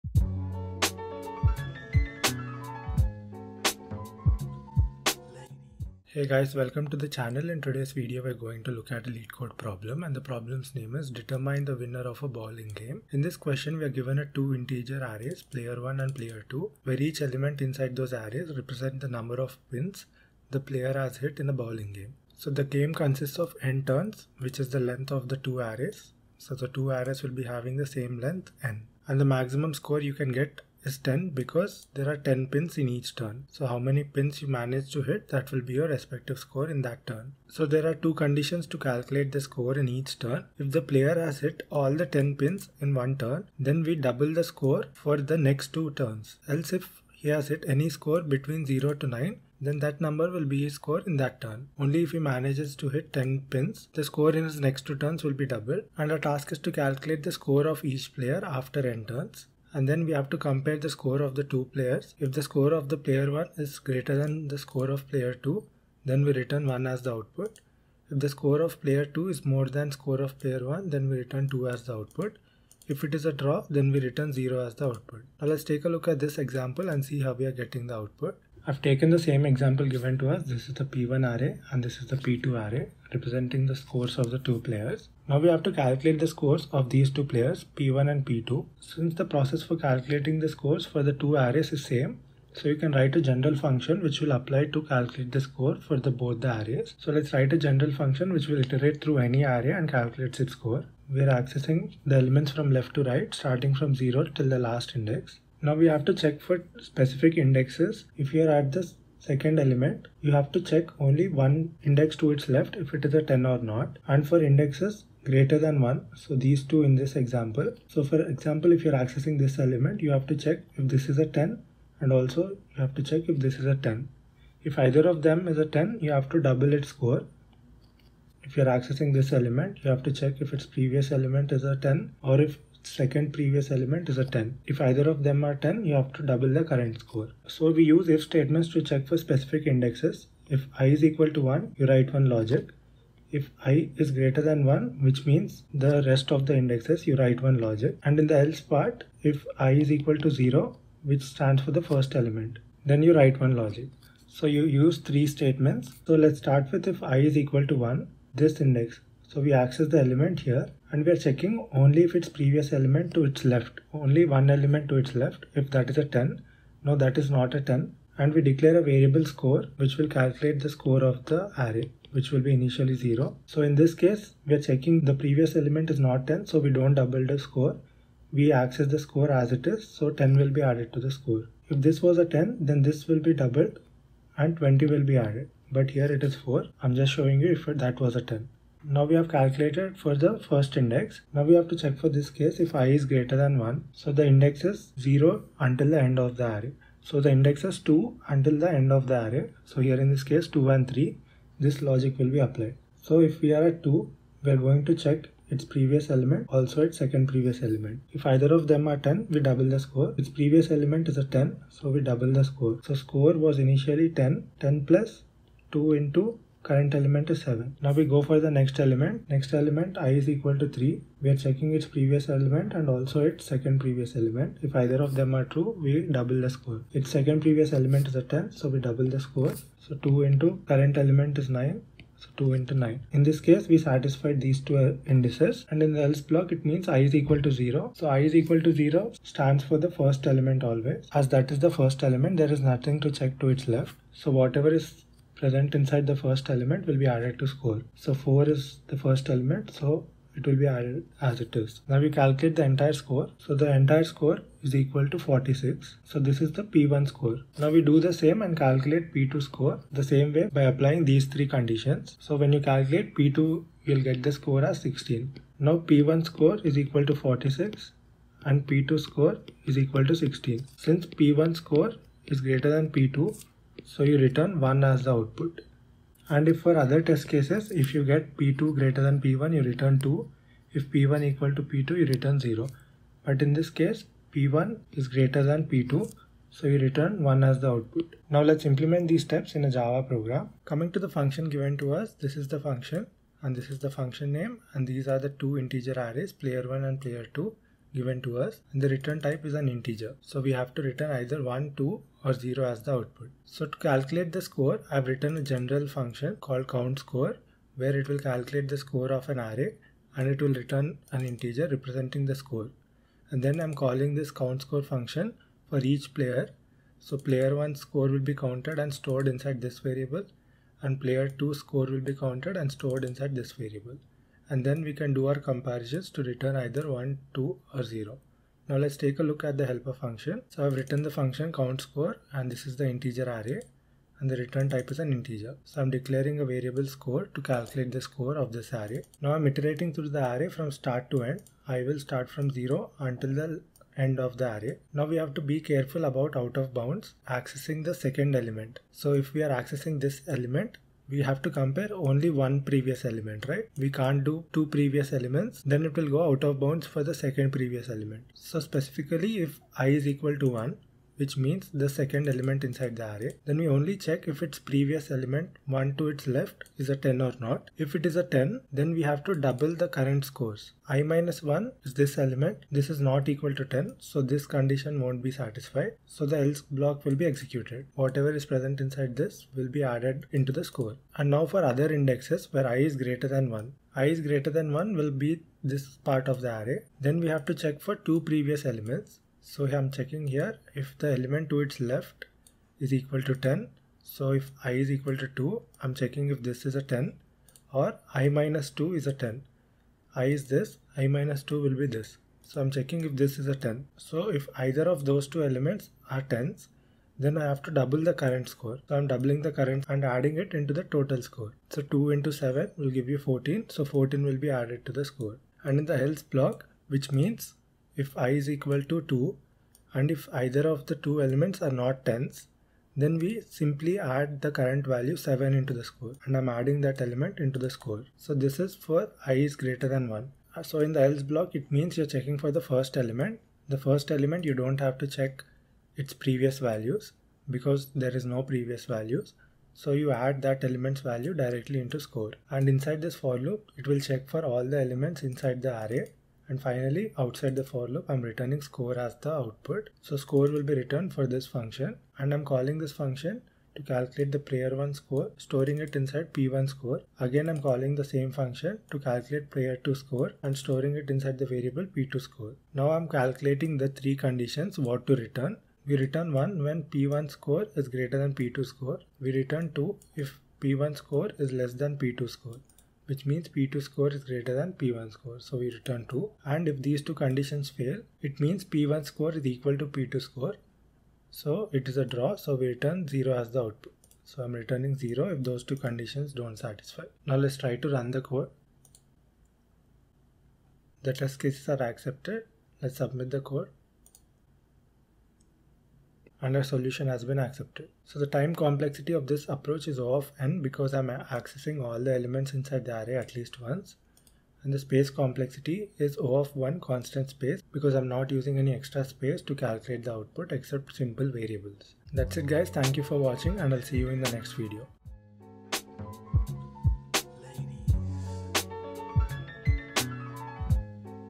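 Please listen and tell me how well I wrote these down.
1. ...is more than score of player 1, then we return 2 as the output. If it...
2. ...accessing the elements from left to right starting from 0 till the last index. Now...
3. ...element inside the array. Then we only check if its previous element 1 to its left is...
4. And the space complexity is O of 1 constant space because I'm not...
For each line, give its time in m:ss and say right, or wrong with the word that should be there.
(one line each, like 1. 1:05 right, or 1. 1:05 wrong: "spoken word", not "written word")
1. 1:09 right
2. 1:41 right
3. 6:02 right
4. 8:24 right.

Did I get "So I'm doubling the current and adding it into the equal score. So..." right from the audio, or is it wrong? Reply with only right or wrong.
wrong.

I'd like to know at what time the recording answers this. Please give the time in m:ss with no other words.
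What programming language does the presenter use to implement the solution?
4:49.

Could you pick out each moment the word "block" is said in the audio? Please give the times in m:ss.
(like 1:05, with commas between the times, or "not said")
3:56, 6:16, 6:56, 7:11.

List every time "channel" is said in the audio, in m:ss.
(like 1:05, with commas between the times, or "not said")
0:07.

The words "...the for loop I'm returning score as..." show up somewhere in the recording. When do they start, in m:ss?
7:27.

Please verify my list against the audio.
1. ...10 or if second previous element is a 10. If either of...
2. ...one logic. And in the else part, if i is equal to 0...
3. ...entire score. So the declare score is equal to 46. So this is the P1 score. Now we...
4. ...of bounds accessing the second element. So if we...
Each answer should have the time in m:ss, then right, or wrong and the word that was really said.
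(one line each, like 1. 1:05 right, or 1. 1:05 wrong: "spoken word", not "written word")
1. 2:11 right
2. 2:27 right
3. 4:12 wrong: "entire", not "declare"
4. 5:46 right.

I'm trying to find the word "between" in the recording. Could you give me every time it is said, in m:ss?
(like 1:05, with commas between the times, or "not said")
0:48.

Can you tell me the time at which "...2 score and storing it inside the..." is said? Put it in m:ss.
7:39.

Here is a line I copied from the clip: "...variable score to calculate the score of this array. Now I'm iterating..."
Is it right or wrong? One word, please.
right.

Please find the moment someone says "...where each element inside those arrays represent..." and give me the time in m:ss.
0:16.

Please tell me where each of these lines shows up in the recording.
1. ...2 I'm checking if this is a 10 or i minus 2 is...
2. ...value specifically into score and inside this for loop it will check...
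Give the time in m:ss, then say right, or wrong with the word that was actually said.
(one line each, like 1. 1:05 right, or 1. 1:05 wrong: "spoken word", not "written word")
1. 6:35 right
2. 7:21 wrong: "directly", not "specifically".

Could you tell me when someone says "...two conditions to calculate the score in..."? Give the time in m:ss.
0:37.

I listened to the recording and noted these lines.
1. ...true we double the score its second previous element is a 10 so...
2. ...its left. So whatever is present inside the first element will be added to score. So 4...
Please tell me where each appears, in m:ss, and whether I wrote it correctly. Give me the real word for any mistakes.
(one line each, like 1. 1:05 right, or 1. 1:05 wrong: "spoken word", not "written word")
1. 3:45 right
2. 4:03 right.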